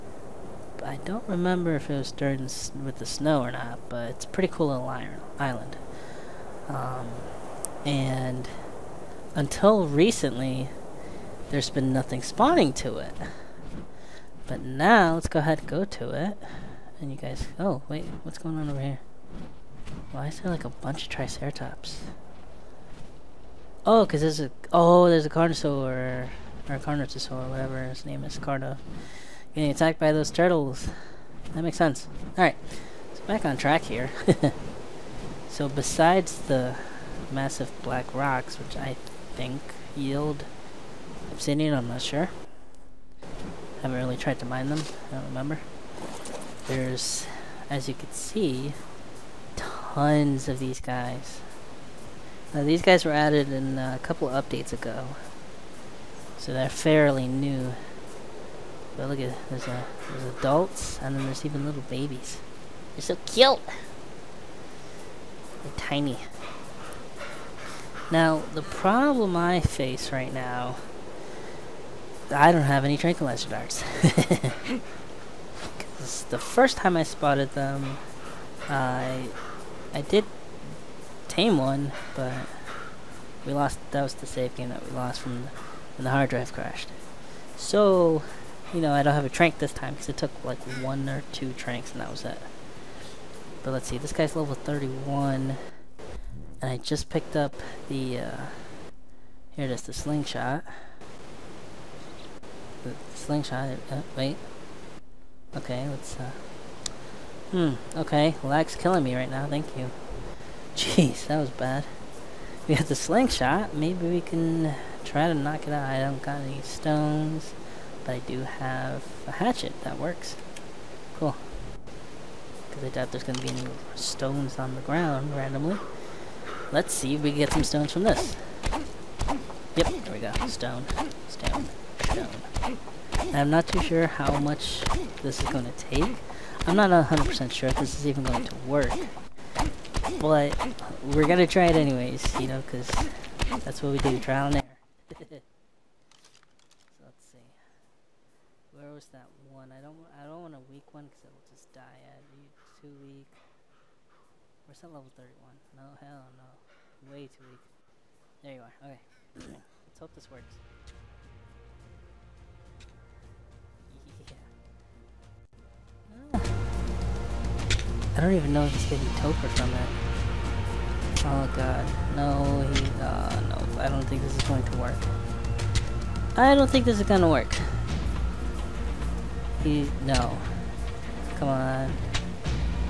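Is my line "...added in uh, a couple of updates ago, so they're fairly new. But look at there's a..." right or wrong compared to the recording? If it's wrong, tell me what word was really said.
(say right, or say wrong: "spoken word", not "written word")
right.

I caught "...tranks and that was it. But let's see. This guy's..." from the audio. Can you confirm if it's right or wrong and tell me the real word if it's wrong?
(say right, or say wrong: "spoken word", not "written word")
right.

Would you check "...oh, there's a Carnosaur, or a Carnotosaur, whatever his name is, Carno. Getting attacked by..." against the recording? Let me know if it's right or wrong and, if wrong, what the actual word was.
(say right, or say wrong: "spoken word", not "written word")
right.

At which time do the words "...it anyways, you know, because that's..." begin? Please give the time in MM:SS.
02:21.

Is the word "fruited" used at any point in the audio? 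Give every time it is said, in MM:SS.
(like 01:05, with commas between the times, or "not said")
not said.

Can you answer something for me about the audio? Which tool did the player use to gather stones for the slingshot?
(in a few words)
hatchet.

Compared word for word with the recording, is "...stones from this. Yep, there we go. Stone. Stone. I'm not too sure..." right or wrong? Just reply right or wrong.
right.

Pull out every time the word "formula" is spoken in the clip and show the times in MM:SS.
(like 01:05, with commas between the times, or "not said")
not said.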